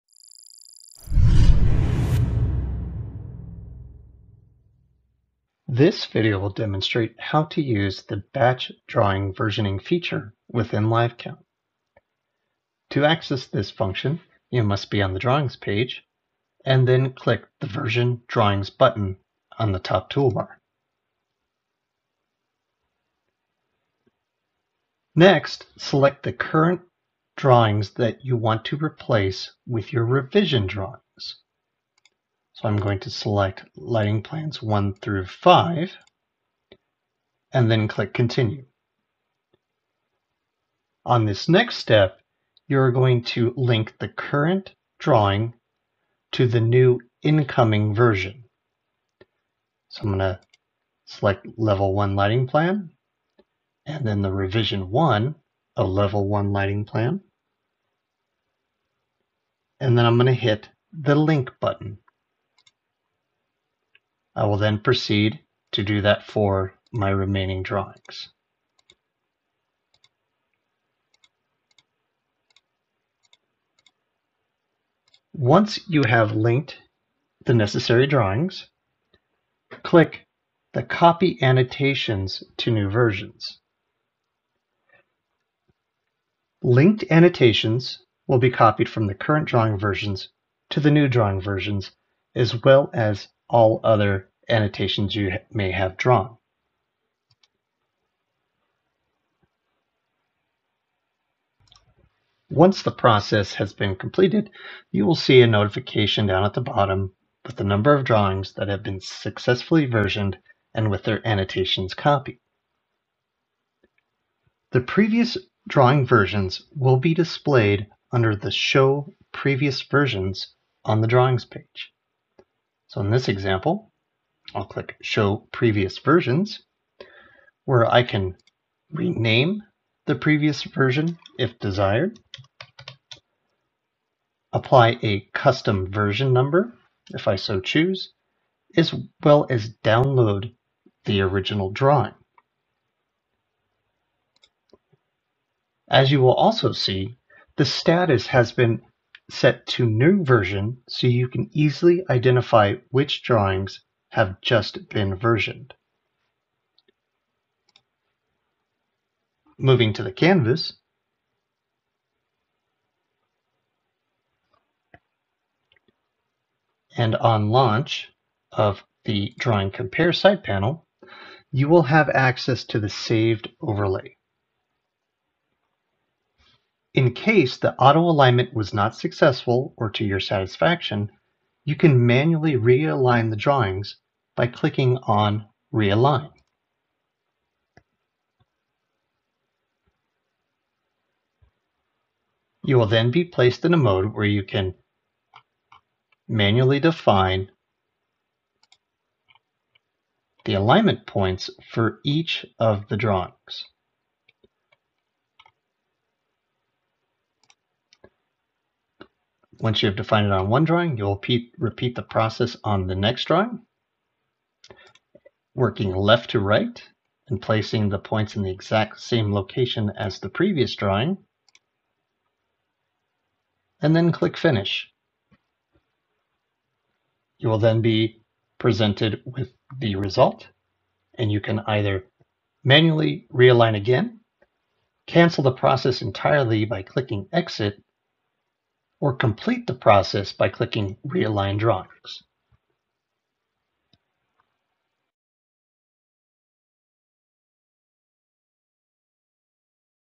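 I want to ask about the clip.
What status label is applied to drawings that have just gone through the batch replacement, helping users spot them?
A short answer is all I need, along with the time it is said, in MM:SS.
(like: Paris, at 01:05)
New version, at 02:29.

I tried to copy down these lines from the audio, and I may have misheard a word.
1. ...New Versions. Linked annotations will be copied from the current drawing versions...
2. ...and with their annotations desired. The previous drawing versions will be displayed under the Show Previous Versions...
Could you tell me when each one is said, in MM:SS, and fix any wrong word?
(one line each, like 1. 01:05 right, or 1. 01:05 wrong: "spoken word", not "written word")
1. 01:22 right
2. 01:50 wrong: "copied", not "desired".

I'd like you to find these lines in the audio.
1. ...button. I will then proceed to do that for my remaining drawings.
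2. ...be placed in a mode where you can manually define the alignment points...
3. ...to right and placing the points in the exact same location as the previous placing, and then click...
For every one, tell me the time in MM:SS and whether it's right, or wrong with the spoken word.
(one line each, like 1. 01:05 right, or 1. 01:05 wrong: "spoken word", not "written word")
1. 01:01 right
2. 03:13 right
3. 03:36 wrong: "drawing", not "placing".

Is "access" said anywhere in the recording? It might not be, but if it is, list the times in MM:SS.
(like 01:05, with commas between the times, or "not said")
00:13, 02:52.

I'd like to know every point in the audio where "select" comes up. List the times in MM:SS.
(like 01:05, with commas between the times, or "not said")
00:25, 00:33, 00:51.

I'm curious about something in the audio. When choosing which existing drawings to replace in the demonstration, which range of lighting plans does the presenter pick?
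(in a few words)
1 through 5.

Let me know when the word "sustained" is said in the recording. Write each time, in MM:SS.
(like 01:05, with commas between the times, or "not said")
not said.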